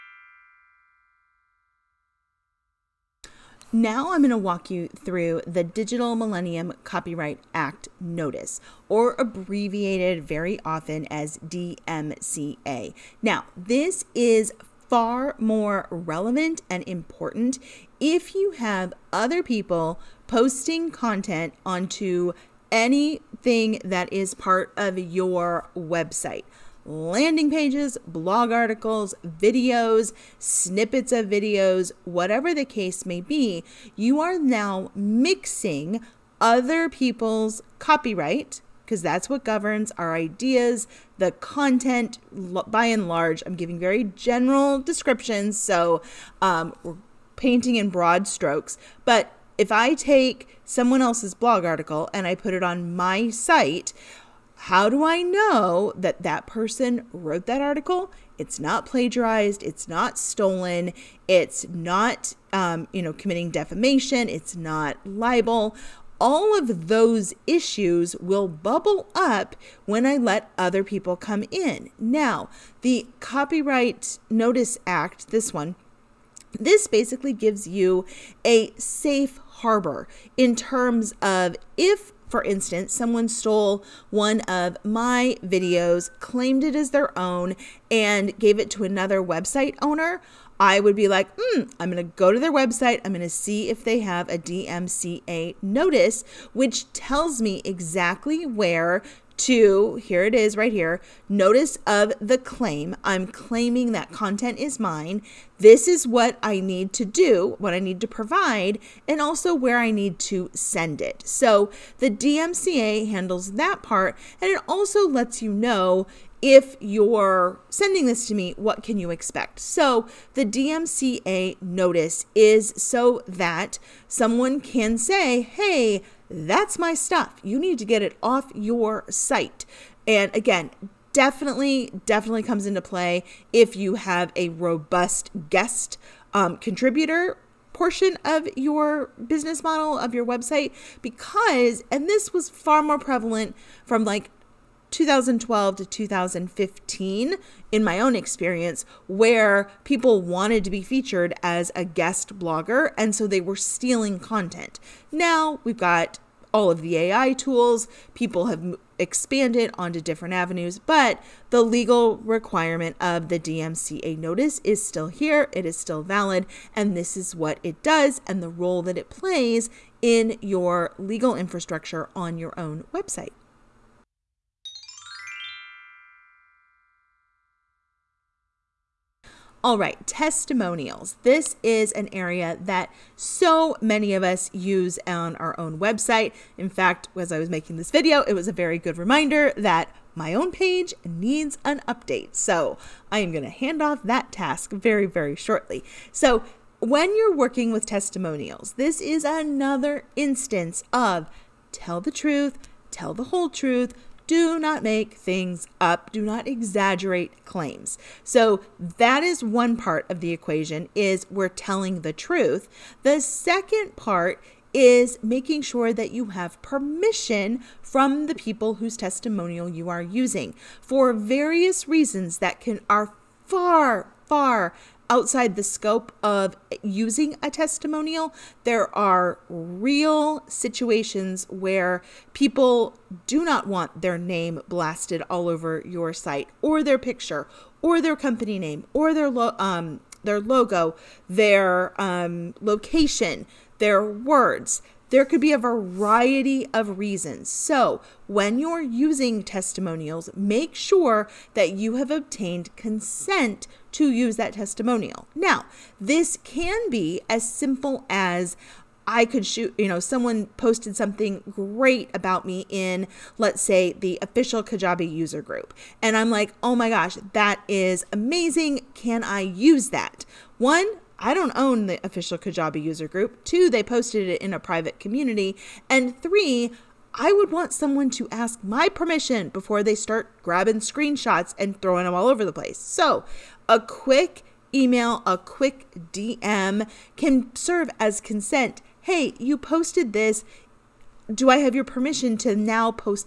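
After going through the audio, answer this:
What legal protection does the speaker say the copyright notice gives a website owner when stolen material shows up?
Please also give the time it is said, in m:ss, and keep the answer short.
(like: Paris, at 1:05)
safe harbor, at 1:18.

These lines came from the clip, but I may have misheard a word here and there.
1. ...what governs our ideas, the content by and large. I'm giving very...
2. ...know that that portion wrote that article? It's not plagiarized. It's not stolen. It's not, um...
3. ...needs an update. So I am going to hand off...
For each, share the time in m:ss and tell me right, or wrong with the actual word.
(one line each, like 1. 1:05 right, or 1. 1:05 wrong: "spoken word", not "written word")
1. 0:39 right
2. 0:55 wrong: "person", not "portion"
3. 3:11 right.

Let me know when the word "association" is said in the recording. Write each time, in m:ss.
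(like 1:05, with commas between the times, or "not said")
not said.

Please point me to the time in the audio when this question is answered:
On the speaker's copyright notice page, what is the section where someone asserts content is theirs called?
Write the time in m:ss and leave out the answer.
1:41.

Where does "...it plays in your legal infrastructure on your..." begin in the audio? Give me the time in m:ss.
2:48.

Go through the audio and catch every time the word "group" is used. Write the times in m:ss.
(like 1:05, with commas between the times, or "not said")
4:25, 4:33.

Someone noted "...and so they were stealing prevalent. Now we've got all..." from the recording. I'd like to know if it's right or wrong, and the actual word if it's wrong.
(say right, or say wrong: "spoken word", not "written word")
wrong: "content", not "prevalent".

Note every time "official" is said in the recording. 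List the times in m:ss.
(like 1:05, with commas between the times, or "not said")
4:24, 4:32.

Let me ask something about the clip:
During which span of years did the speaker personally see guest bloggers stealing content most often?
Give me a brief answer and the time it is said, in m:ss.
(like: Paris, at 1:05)
2012 to 2015, at 2:24.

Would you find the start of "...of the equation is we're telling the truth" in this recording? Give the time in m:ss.
3:30.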